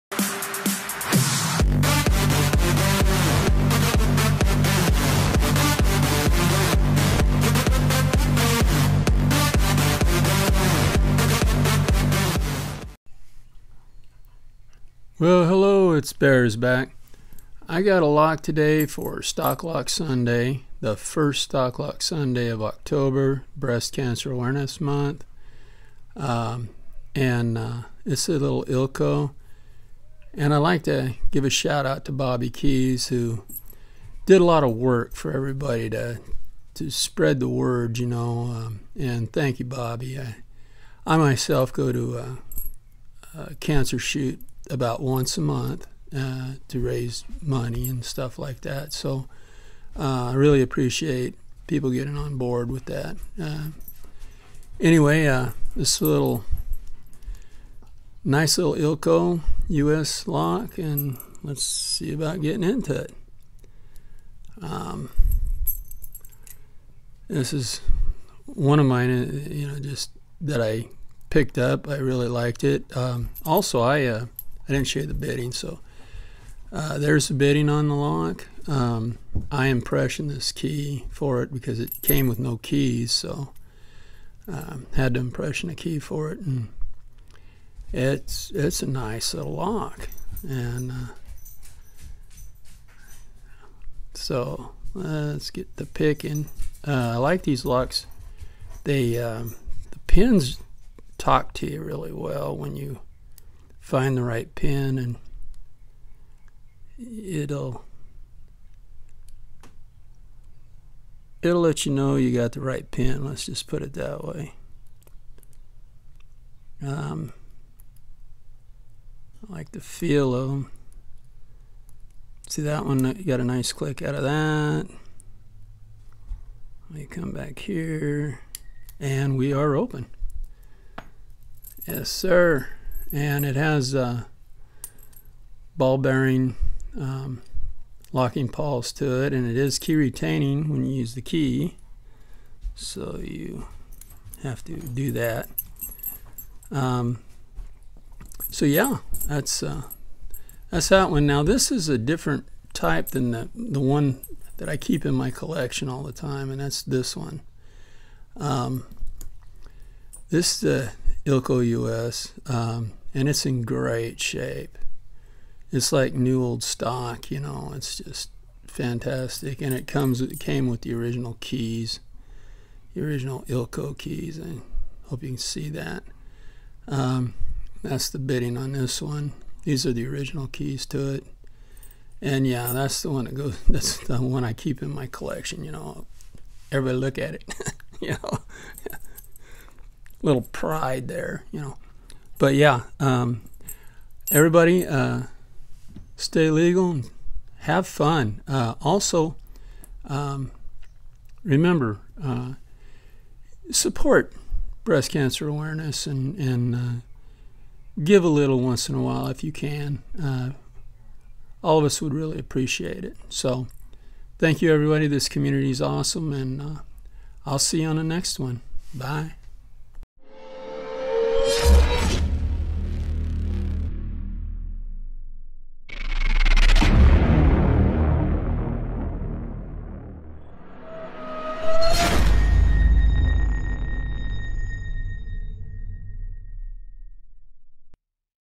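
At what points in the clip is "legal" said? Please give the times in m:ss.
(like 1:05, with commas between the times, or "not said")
3:16.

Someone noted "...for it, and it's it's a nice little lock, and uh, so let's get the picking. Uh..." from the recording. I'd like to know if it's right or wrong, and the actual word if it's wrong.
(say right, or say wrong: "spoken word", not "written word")
right.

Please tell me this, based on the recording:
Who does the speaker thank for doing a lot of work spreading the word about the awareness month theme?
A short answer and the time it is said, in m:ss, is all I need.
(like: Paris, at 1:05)
Bobby Keys, at 0:32.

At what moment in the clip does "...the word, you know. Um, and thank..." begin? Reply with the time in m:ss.
0:37.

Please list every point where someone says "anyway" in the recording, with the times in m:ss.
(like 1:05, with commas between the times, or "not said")
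0:54.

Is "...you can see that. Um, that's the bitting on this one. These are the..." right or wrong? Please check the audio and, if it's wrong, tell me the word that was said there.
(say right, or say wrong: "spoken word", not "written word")
right.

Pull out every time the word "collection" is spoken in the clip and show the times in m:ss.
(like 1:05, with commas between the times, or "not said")
2:35, 3:05.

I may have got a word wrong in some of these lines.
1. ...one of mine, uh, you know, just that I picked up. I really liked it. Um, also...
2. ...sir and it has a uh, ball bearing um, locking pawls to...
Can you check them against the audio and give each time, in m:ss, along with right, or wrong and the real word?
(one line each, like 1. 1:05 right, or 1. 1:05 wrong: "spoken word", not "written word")
1. 1:08 right
2. 2:12 right.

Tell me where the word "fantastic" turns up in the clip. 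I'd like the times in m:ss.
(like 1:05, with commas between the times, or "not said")
2:48.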